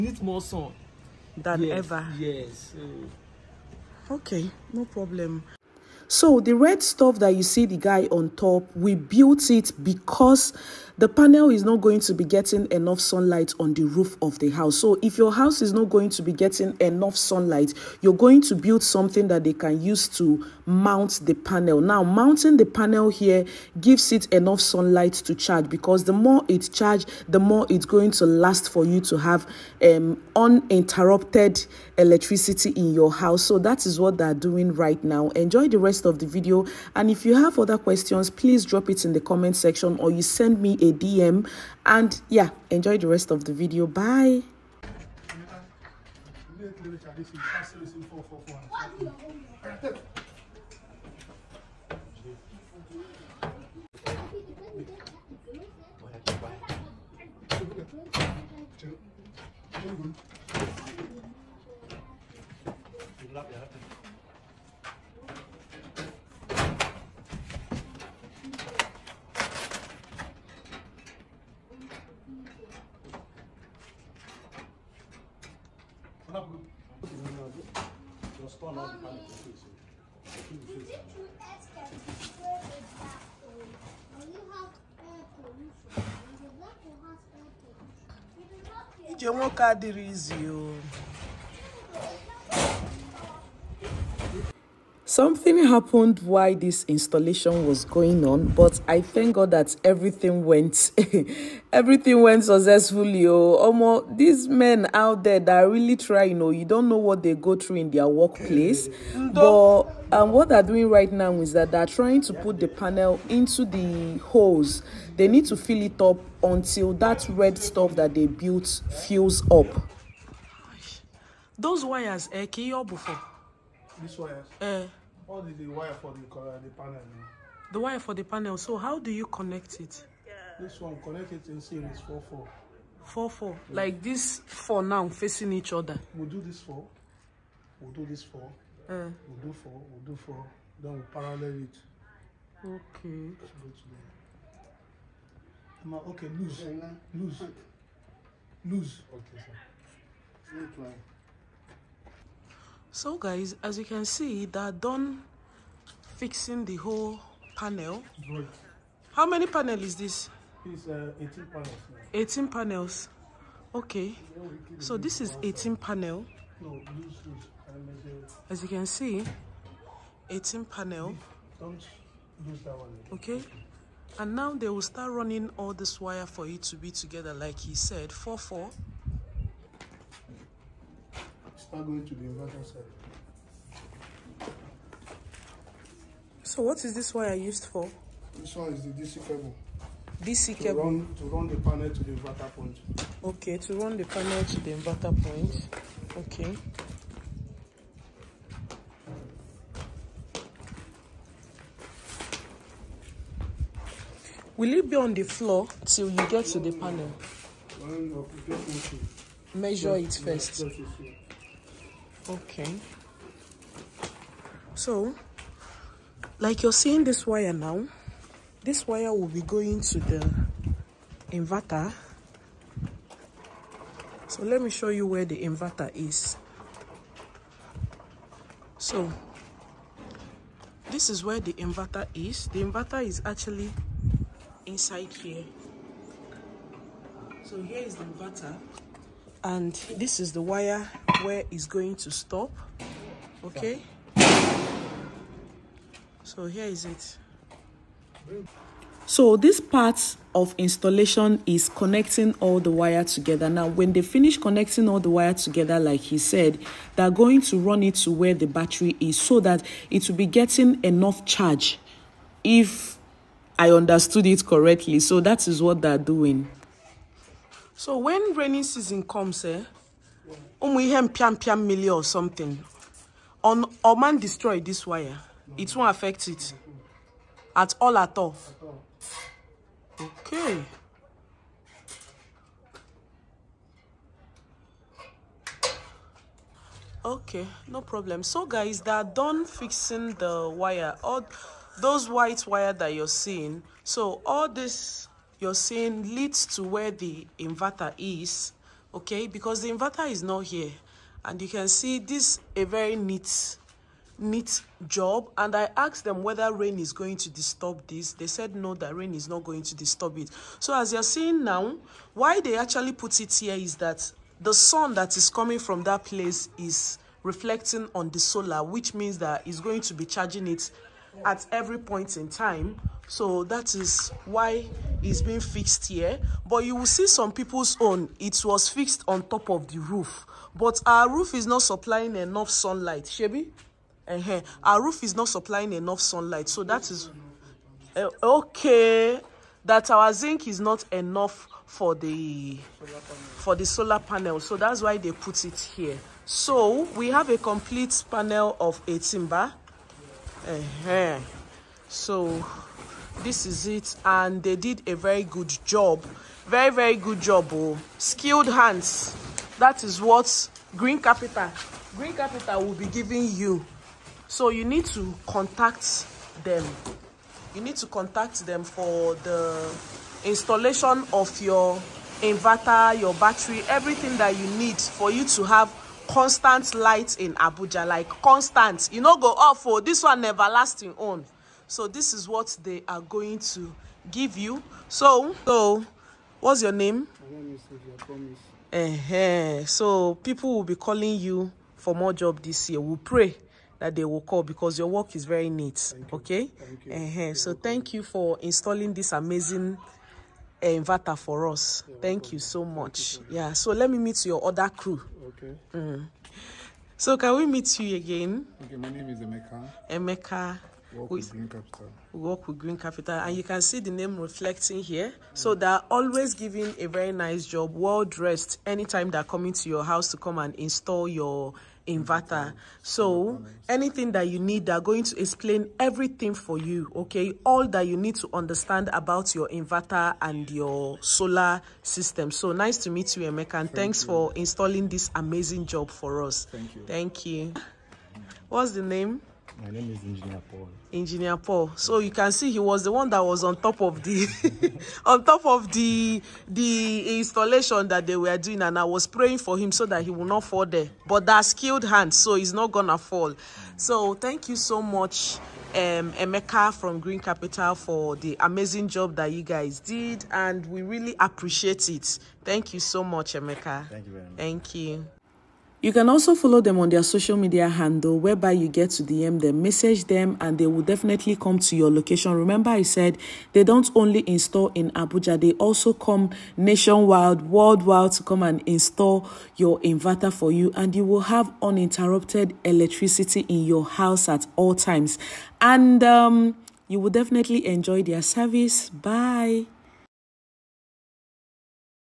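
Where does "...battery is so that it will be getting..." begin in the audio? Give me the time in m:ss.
4:18.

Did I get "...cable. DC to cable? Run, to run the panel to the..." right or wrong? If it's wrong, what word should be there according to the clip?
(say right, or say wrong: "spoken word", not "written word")
right.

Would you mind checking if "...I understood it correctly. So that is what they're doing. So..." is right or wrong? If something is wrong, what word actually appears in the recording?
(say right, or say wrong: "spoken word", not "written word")
right.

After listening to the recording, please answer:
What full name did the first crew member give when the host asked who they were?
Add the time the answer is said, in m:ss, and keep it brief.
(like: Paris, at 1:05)
Sylvia Promise, at 6:27.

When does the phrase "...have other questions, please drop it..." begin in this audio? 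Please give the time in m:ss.
0:37.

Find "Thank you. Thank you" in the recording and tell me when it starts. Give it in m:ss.
7:16.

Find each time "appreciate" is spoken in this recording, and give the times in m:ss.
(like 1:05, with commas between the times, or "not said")
7:41.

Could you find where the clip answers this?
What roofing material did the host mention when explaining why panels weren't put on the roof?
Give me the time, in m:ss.
5:40.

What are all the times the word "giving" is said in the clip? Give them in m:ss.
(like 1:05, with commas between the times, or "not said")
6:02, 6:56.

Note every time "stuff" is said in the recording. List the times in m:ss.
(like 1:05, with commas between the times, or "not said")
0:06, 1:57.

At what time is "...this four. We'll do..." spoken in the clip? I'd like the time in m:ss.
2:16.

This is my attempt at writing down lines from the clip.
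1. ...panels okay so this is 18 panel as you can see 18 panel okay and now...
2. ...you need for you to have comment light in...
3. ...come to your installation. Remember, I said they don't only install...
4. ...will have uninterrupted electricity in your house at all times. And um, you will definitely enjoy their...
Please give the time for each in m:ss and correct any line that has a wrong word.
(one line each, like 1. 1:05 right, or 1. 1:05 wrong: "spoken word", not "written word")
1. 2:42 right
2. 6:14 wrong: "constant", not "comment"
3. 7:51 wrong: "location", not "installation"
4. 8:01 right.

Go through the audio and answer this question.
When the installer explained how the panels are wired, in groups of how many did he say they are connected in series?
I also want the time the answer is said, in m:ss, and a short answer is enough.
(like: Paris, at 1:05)
4, at 2:12.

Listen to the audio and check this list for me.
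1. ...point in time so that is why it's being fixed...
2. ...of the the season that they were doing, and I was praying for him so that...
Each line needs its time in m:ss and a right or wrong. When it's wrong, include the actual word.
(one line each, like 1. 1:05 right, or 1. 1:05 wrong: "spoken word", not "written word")
1. 5:21 right
2. 7:25 wrong: "installation", not "season".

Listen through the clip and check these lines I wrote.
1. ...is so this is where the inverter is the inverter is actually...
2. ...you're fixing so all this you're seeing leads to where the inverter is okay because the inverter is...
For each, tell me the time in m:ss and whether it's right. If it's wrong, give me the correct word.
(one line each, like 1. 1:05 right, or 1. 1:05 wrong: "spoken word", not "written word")
1. 3:45 right
2. 4:52 wrong: "seeing", not "fixing".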